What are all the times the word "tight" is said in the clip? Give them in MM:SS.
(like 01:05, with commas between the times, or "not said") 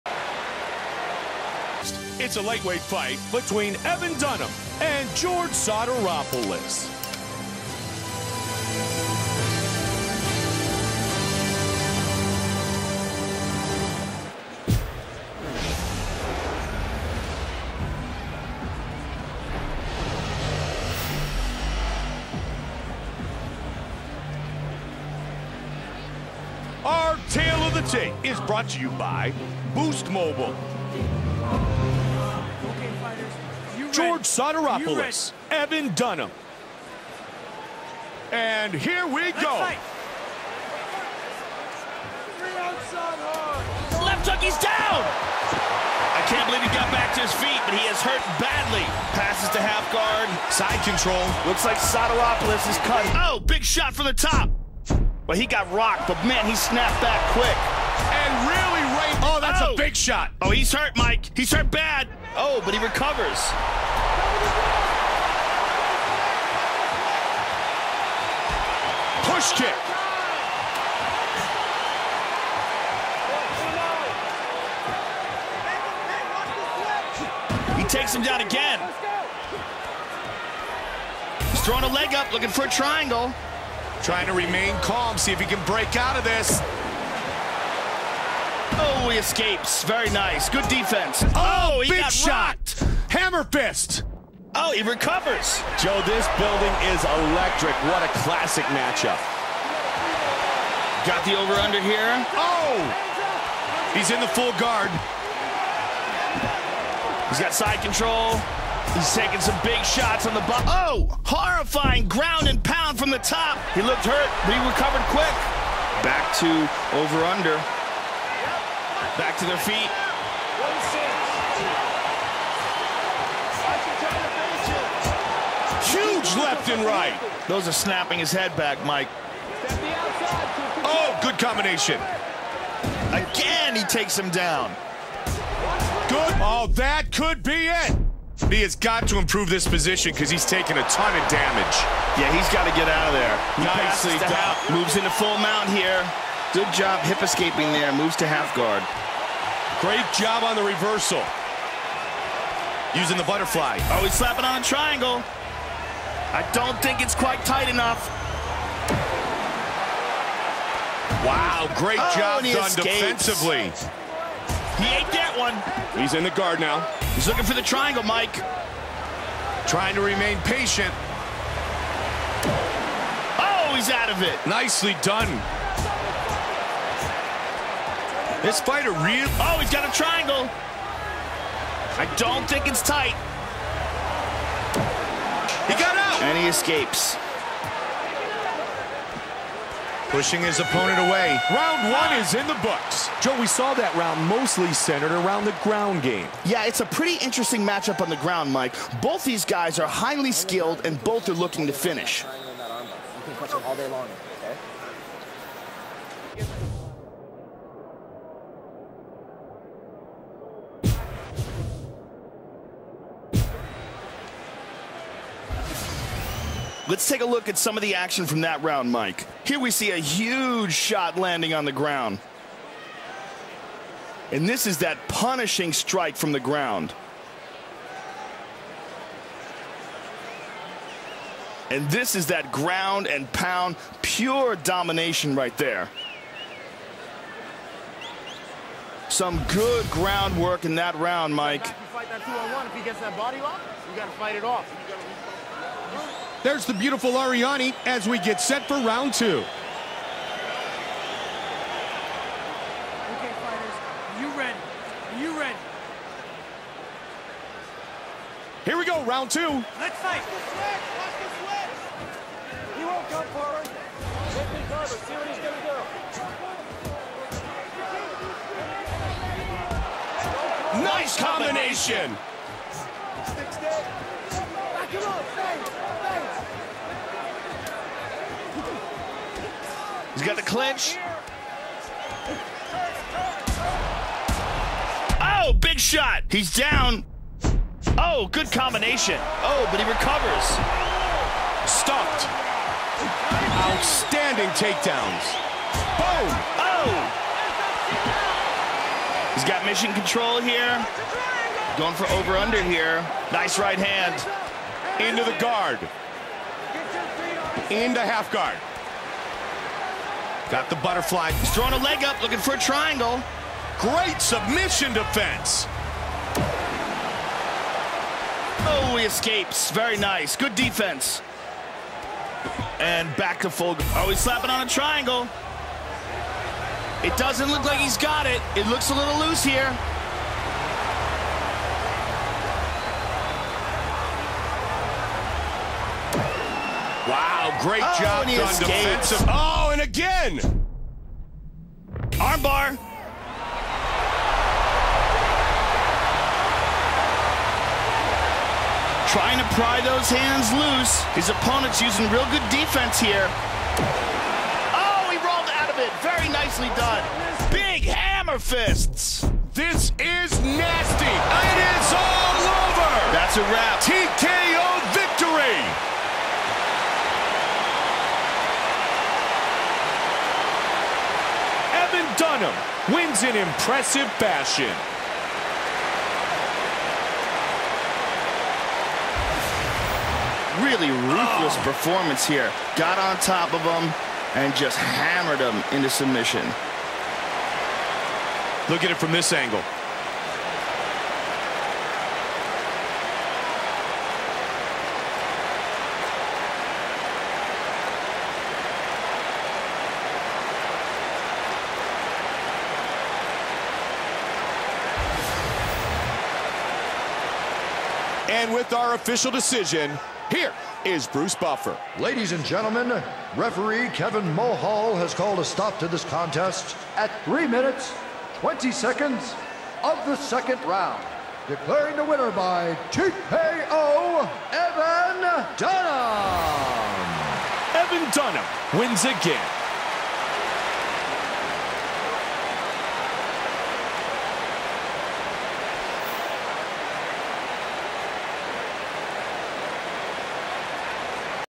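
02:37, 03:02.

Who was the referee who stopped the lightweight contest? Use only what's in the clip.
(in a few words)
Kevin Mulhall.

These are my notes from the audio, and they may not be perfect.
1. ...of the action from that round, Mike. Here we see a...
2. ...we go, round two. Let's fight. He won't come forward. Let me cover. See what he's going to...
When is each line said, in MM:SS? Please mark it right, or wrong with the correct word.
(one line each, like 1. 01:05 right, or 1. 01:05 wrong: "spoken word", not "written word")
1. 03:37 right
2. 04:18 right.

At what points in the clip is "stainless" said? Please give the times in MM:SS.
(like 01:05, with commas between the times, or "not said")
not said.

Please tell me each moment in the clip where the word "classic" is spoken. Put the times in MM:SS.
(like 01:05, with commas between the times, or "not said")
01:38.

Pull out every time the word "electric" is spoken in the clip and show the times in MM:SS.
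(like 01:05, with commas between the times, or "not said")
01:37.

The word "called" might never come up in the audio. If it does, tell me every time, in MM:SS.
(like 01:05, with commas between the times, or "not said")
06:55.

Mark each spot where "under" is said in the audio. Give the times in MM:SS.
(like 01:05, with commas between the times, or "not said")
01:41, 01:56, 05:02.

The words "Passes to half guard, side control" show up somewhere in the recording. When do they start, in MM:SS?
00:49.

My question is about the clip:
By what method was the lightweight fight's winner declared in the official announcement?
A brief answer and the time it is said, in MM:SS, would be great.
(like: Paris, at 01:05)
TKO, at 07:02.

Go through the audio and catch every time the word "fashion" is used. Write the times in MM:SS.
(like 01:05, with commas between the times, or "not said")
06:14.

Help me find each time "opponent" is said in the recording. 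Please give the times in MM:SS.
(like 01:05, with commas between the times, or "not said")
03:10, 05:51.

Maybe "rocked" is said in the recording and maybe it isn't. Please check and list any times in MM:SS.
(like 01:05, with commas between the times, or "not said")
00:55, 01:32.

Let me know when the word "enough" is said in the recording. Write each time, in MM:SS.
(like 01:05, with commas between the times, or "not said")
02:37.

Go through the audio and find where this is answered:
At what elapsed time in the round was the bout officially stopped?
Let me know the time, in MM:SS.
06:57.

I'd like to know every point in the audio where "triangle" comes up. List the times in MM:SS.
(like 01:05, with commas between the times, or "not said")
01:22, 02:34, 02:47, 02:59, 05:12, 05:24.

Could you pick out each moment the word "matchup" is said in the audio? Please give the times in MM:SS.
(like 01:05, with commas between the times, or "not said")
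01:38, 03:17.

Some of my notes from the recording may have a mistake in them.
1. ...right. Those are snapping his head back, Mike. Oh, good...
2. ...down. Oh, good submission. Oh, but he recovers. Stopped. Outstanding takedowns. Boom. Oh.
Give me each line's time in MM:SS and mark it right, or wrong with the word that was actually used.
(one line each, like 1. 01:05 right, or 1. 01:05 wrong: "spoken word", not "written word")
1. 02:06 right
2. 04:46 wrong: "combination", not "submission".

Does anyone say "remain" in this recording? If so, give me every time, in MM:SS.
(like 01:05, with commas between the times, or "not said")
01:24, 02:50.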